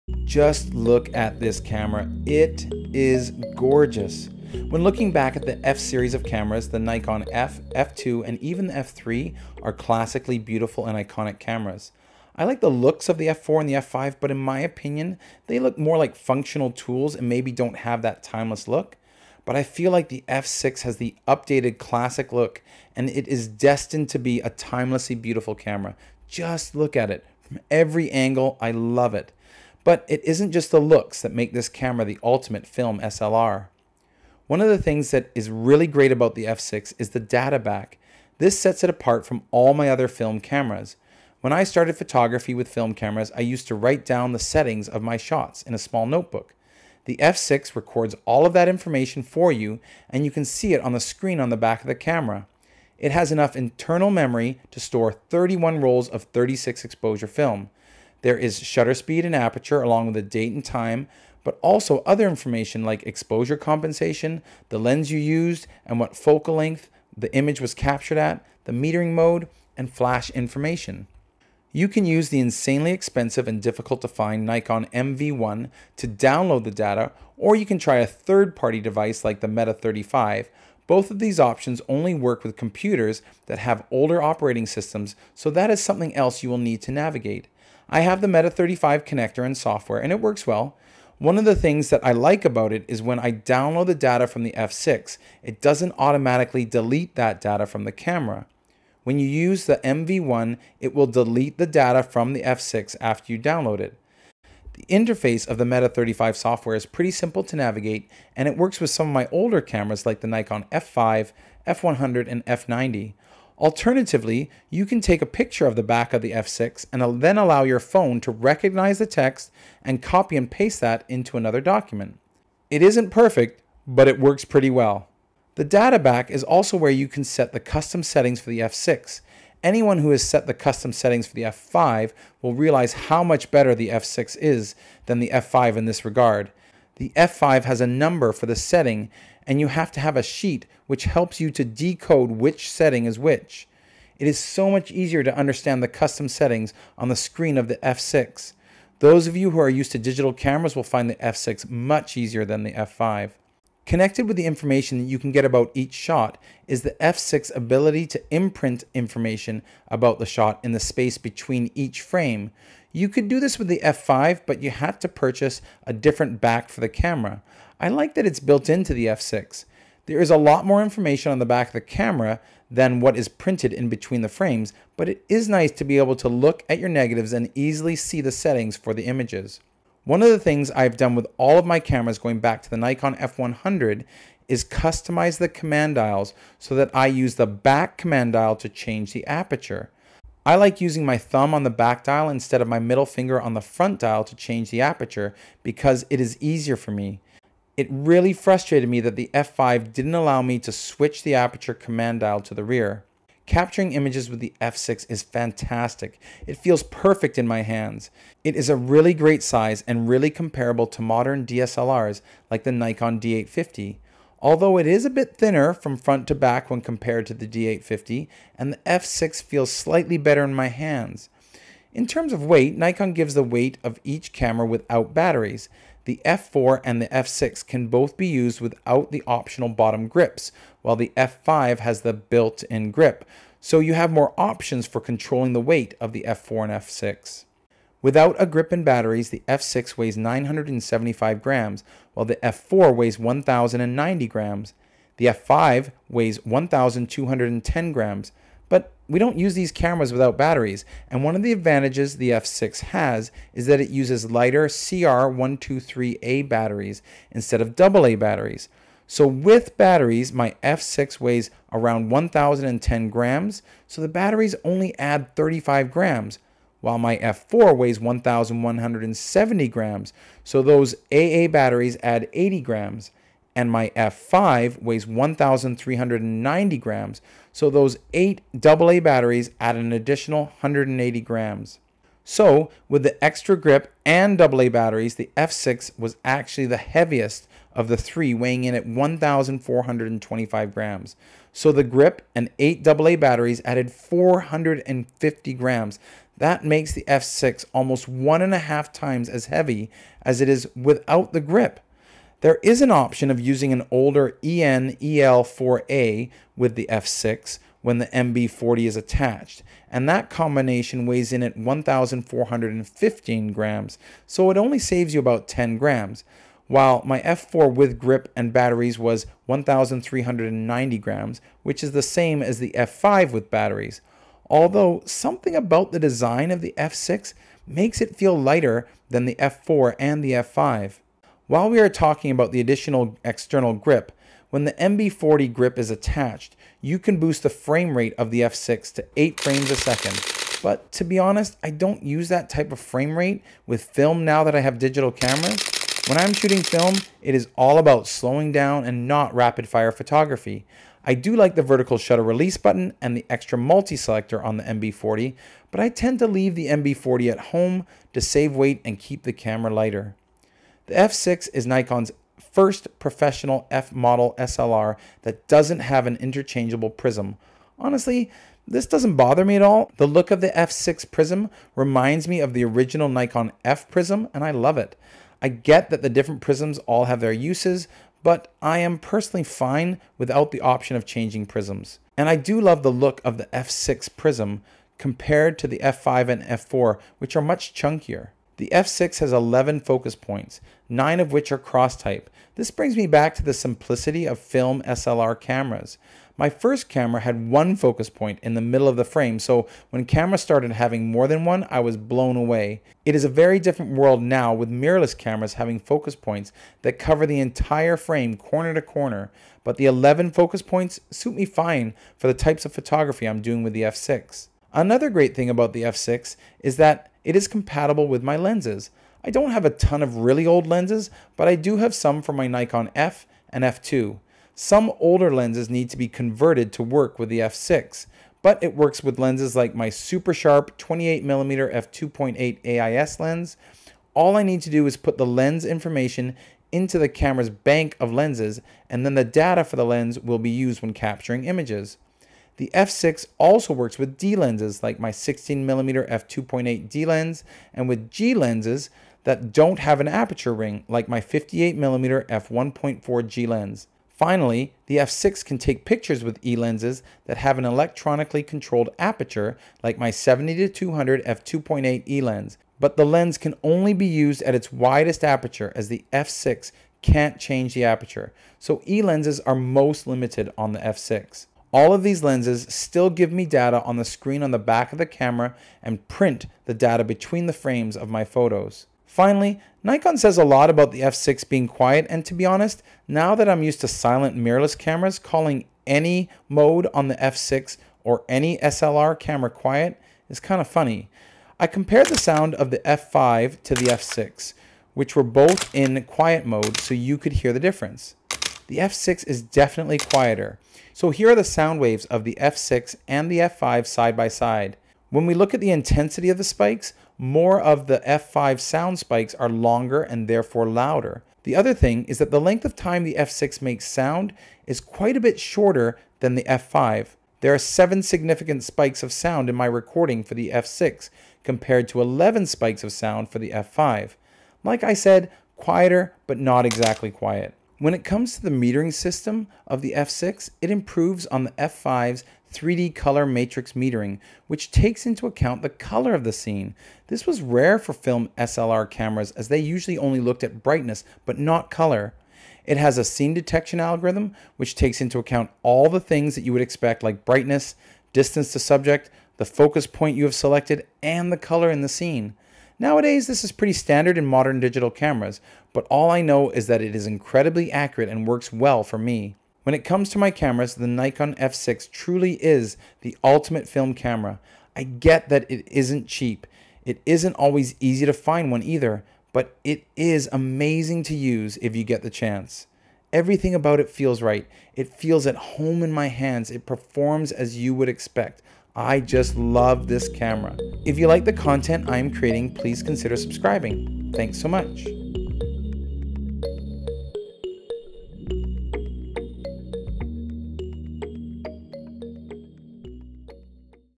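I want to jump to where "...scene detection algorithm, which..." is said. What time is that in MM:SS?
09:03.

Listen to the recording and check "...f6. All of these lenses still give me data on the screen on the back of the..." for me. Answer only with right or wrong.
right.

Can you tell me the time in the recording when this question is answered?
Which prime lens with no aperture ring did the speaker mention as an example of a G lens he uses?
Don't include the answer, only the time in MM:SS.
07:31.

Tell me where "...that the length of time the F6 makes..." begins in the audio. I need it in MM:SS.
08:32.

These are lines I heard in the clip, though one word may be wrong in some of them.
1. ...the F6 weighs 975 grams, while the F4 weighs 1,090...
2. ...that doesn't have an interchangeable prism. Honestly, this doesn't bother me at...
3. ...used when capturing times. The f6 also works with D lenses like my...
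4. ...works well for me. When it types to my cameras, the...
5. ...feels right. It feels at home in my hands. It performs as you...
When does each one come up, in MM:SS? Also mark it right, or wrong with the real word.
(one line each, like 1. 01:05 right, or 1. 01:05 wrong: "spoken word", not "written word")
1. 03:59 right
2. 06:05 right
3. 07:20 wrong: "images", not "times"
4. 09:18 wrong: "comes", not "types"
5. 09:33 right.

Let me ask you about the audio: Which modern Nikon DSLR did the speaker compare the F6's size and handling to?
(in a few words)
Nikon D850.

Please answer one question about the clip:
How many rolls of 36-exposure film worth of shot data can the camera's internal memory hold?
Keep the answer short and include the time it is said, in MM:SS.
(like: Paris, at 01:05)
31, at 00:55.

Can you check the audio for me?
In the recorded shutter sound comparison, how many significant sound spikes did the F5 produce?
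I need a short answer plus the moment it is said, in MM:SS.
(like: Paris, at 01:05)
11, at 08:42.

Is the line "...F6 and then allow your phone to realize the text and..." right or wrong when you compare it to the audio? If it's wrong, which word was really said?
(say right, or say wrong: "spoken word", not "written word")
wrong: "recognize", not "realize".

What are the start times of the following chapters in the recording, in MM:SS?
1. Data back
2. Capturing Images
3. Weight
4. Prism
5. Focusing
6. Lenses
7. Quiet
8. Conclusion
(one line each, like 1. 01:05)
1. 00:34
2. 03:23
3. 03:42
4. 06:00
5. 06:28
6. 06:54
7. 07:59
8. 08:47.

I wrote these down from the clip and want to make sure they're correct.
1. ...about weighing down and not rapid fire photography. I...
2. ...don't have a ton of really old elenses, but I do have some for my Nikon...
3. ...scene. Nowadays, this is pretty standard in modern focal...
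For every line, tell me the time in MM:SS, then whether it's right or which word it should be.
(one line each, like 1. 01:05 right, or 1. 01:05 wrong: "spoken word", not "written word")
1. 05:47 wrong: "slowing", not "weighing"
2. 06:59 wrong: "lenses", not "elenses"
3. 09:11 wrong: "digital", not "focal".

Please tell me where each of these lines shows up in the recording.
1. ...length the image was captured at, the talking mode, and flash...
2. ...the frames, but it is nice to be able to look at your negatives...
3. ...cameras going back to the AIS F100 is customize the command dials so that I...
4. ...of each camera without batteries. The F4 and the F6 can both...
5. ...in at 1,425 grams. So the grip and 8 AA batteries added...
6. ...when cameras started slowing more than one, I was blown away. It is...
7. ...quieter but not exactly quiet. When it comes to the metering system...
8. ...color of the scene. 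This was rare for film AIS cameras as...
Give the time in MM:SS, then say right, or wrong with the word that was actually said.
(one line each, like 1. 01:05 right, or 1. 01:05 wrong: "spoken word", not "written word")
1. 01:06 wrong: "metering", not "talking"
2. 02:54 right
3. 03:01 wrong: "Nikon", not "AIS"
4. 03:43 right
5. 04:48 right
6. 06:39 wrong: "having", not "slowing"
7. 08:45 right
8. 08:55 wrong: "SLR", not "AIS".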